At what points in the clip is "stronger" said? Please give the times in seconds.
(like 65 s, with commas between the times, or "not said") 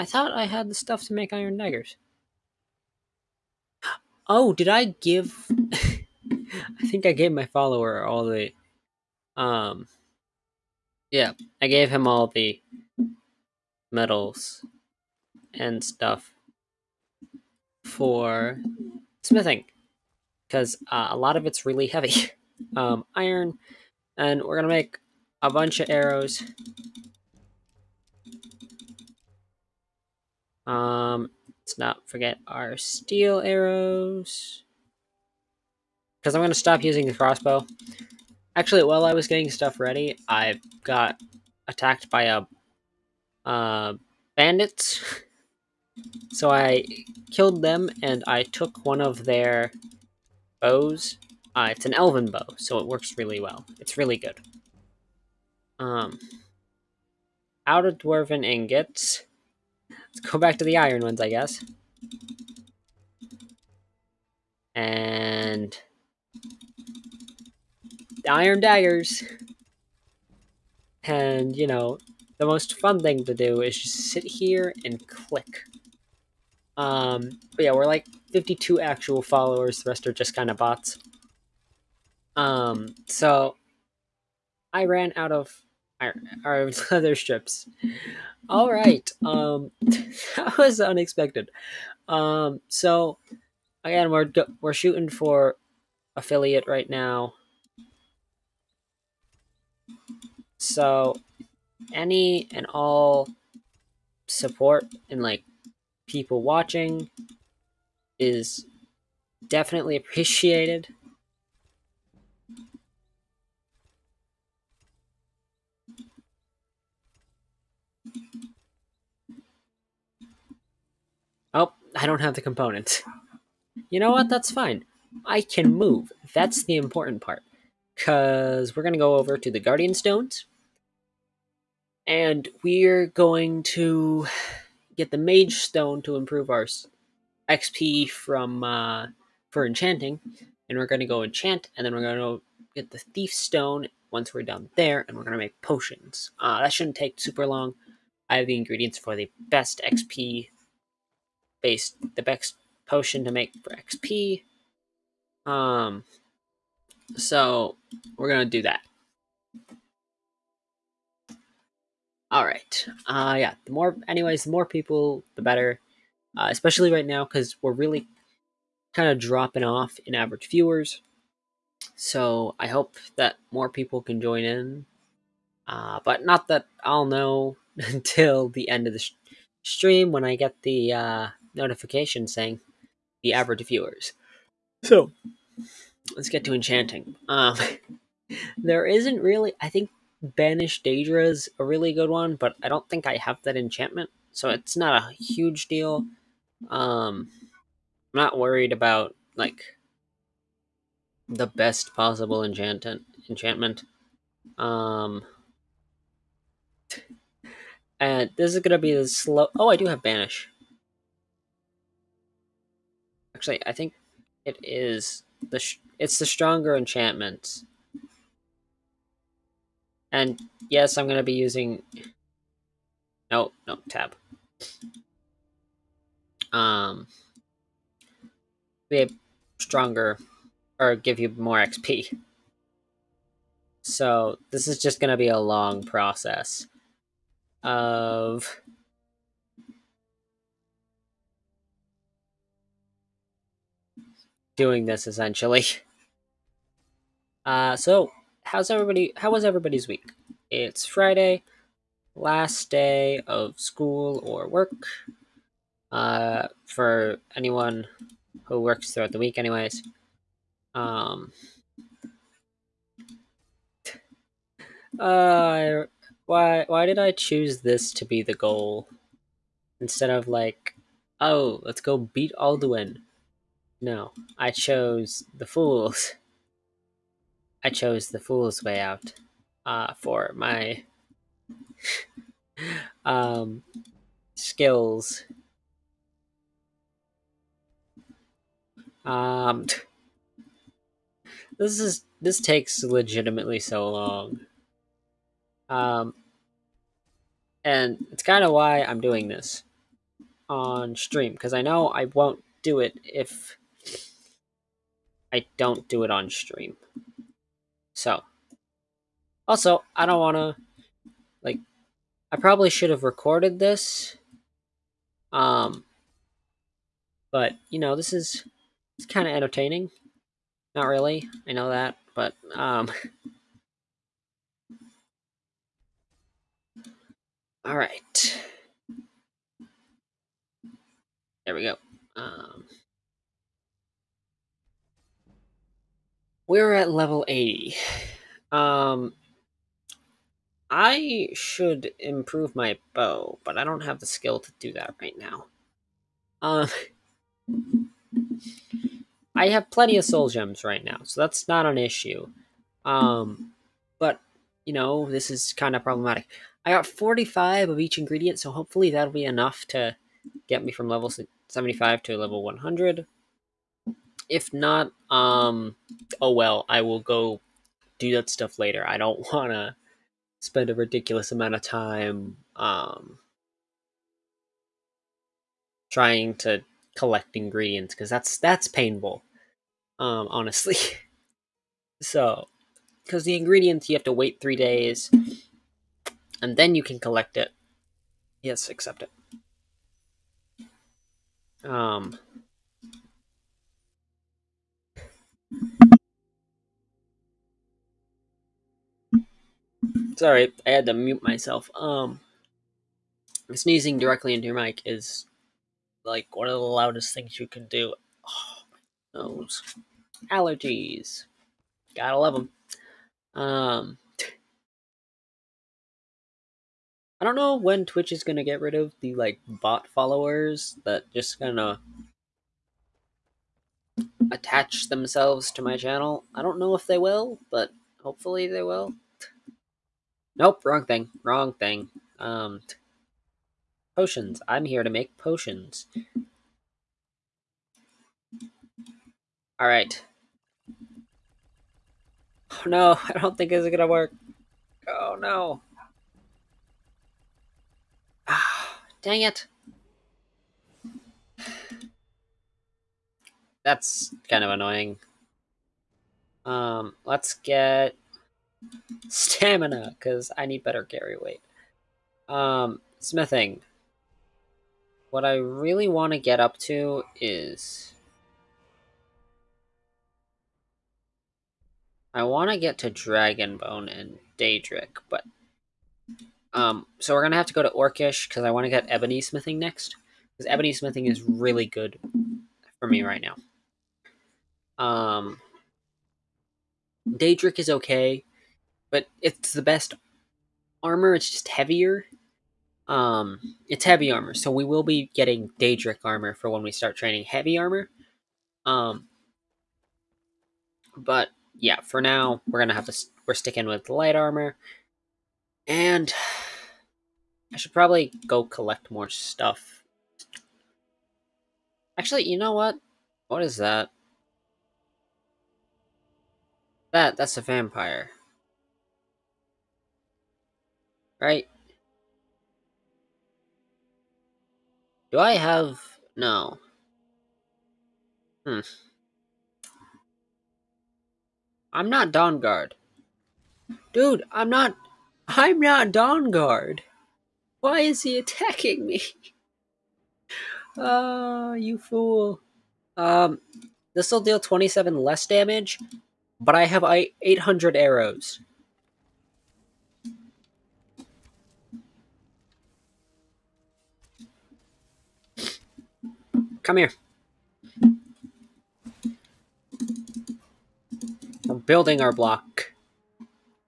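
216 s, 229 s.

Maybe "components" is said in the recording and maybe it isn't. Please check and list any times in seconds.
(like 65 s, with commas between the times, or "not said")
122 s.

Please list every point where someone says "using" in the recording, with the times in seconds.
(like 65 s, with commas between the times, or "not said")
36 s, 221 s.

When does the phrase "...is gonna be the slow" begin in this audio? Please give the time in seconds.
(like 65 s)
208 s.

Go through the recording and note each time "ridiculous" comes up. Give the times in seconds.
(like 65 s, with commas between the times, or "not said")
370 s.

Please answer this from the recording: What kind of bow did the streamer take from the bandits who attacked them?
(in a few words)
elven bow.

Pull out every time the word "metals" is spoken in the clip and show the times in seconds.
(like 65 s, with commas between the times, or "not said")
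13 s.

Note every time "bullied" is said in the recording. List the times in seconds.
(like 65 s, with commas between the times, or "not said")
not said.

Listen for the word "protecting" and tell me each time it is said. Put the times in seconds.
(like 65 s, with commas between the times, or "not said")
not said.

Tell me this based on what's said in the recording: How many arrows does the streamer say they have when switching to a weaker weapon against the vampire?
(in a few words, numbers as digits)
800.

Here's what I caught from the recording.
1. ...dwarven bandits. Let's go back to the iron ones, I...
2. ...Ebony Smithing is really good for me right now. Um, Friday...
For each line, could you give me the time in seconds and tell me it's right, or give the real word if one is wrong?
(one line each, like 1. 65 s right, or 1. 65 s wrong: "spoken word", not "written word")
1. 57 s wrong: "ingots", not "bandits"
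2. 480 s wrong: "Daedric", not "Friday".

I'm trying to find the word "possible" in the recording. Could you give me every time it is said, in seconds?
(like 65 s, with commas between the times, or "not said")
201 s.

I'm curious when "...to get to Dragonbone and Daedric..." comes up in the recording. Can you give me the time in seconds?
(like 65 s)
472 s.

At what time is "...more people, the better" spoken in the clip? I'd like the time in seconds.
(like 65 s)
164 s.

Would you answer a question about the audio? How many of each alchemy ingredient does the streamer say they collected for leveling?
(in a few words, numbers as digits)
45.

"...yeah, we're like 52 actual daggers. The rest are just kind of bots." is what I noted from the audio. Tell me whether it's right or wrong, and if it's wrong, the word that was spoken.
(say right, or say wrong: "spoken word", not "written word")
wrong: "followers", not "daggers".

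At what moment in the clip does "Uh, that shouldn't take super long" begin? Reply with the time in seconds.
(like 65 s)
146 s.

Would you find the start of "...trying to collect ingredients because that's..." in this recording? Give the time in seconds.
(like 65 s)
375 s.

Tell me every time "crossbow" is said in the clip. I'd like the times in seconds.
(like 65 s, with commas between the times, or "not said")
37 s.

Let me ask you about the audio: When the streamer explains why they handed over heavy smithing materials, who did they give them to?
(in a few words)
follower.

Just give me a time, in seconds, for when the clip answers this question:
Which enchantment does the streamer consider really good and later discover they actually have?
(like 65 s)
190 s.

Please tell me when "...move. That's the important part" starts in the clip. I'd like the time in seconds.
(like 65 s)
125 s.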